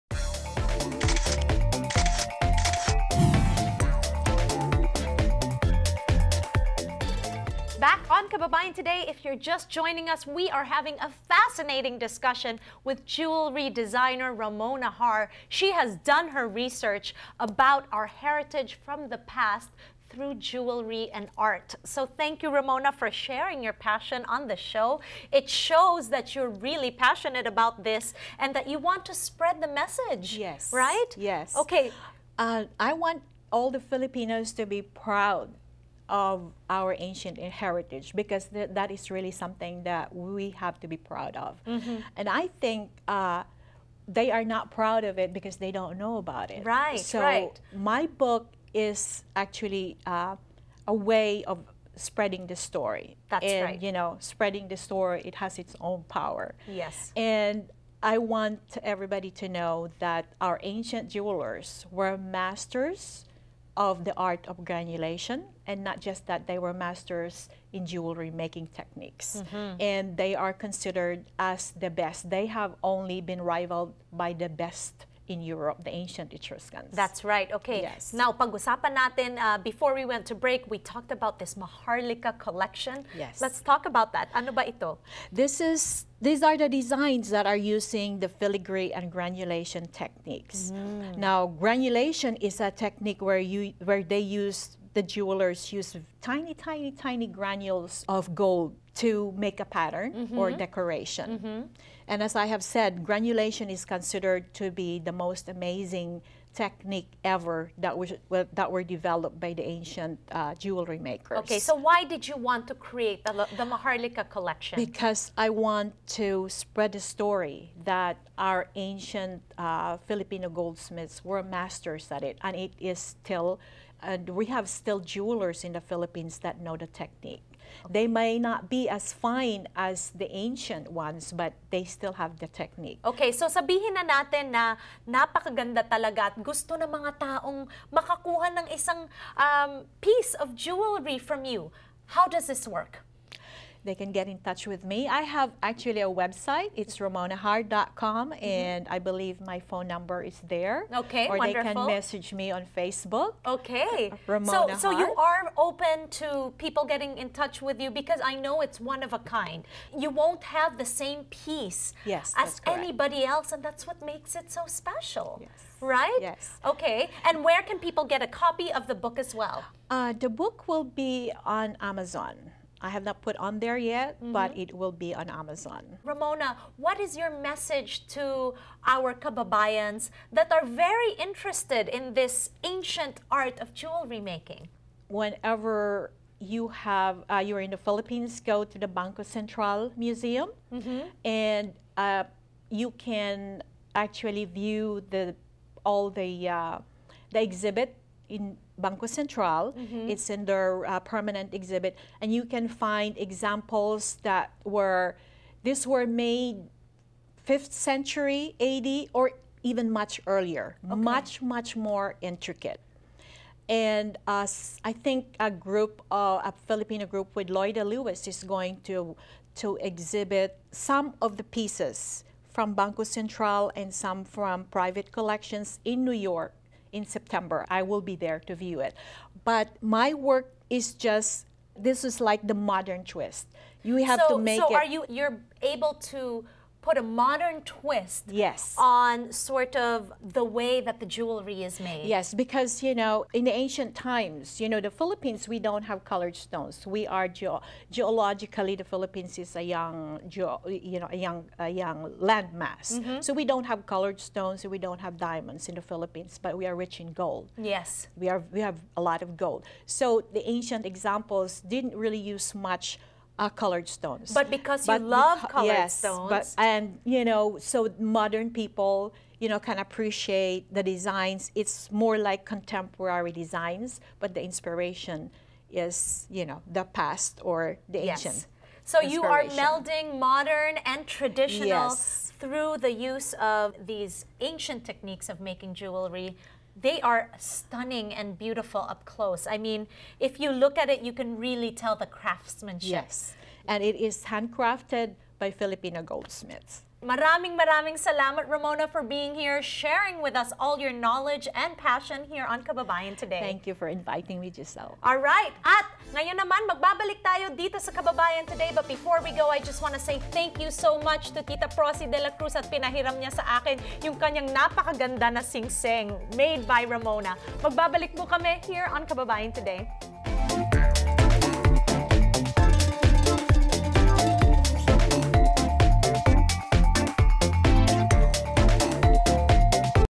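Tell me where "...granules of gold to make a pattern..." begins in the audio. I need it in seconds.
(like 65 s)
97 s.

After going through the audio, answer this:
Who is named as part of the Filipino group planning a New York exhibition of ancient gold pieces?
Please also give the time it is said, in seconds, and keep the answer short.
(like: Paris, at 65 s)
Loida Lewis, at 217 s.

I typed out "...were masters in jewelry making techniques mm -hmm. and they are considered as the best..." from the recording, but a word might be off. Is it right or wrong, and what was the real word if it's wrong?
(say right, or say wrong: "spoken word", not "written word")
right.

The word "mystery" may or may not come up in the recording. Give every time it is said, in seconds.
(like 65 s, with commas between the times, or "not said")
not said.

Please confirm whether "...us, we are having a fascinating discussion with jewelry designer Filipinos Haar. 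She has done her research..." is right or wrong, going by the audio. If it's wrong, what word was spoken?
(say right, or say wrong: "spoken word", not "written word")
wrong: "Ramona", not "Filipinos".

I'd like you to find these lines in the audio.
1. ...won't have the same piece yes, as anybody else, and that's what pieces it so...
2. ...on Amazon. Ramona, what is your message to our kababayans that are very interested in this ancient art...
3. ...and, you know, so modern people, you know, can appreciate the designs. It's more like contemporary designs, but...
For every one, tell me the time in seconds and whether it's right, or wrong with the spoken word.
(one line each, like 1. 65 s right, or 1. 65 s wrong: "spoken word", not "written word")
1. 160 s wrong: "makes", not "pieces"
2. 175 s right
3. 266 s right.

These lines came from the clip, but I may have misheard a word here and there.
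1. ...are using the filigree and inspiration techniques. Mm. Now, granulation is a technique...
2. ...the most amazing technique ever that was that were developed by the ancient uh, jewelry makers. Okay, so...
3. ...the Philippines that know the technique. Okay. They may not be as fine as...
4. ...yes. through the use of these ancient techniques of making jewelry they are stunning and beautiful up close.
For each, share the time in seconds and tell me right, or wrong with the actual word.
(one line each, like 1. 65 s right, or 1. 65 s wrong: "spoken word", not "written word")
1. 87 s wrong: "granulation", not "inspiration"
2. 105 s right
3. 125 s right
4. 281 s right.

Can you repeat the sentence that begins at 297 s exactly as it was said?
Maraming maraming salamat Ramona for being here, sharing with us all your knowledge and passion here on Kababayan today.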